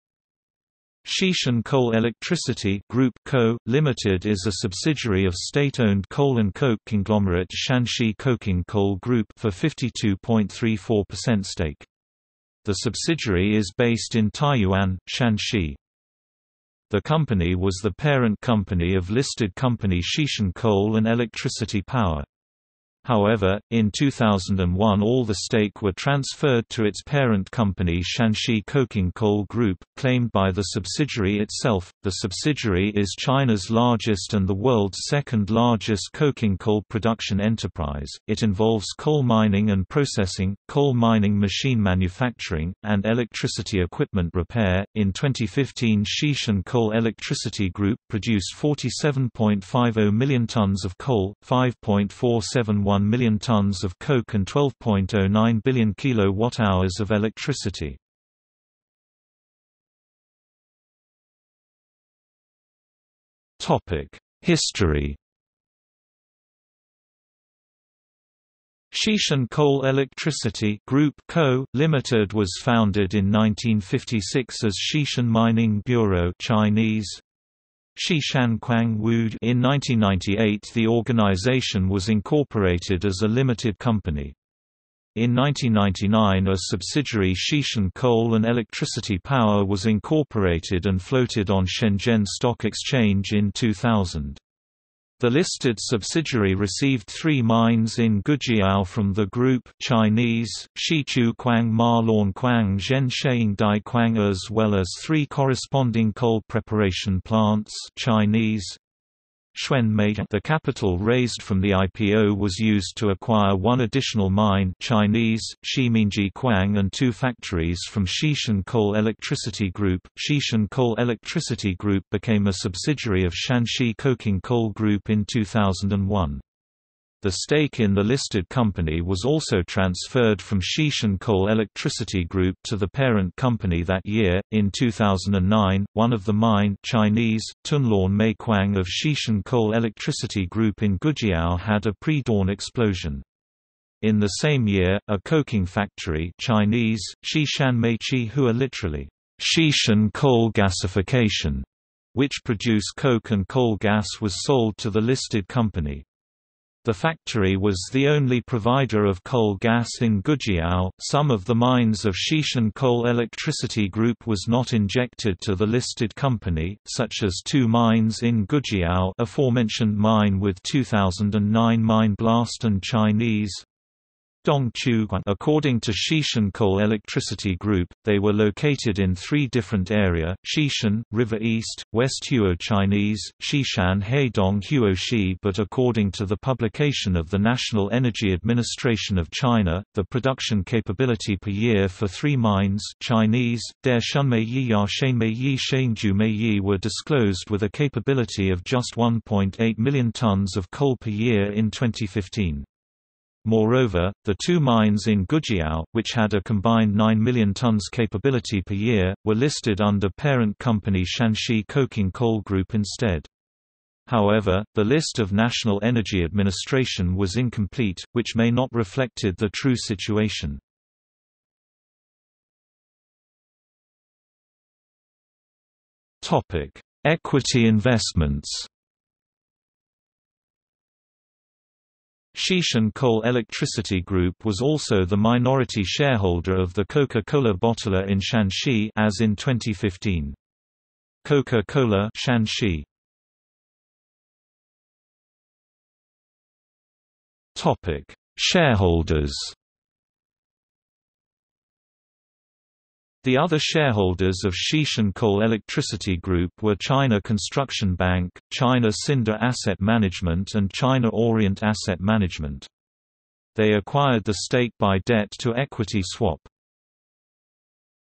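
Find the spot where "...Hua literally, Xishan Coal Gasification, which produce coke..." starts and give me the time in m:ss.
2:28.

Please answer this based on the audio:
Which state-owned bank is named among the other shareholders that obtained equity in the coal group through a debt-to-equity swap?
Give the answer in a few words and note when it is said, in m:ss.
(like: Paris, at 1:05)
China Construction Bank, at 4:16.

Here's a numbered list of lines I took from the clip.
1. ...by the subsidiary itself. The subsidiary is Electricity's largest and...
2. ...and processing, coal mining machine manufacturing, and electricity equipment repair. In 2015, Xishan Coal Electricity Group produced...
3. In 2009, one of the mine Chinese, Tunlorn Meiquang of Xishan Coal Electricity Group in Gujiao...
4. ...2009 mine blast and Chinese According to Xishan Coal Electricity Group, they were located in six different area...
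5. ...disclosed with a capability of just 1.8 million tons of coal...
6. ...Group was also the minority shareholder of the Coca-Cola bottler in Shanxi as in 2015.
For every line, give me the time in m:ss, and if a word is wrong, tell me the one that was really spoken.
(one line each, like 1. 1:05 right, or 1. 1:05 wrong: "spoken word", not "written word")
1. 0:30 wrong: "China", not "Electricity"
2. 0:39 right
3. 2:14 right
4. 2:50 wrong: "three", not "six"
5. 3:16 right
6. 3:54 right.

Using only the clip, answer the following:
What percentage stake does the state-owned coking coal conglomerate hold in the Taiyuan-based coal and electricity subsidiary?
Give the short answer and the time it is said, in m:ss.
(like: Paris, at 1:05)
52.34%, at 0:09.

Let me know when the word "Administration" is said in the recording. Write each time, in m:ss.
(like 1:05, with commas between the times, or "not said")
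3:08, 3:36.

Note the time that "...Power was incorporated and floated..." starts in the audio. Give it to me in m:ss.
1:29.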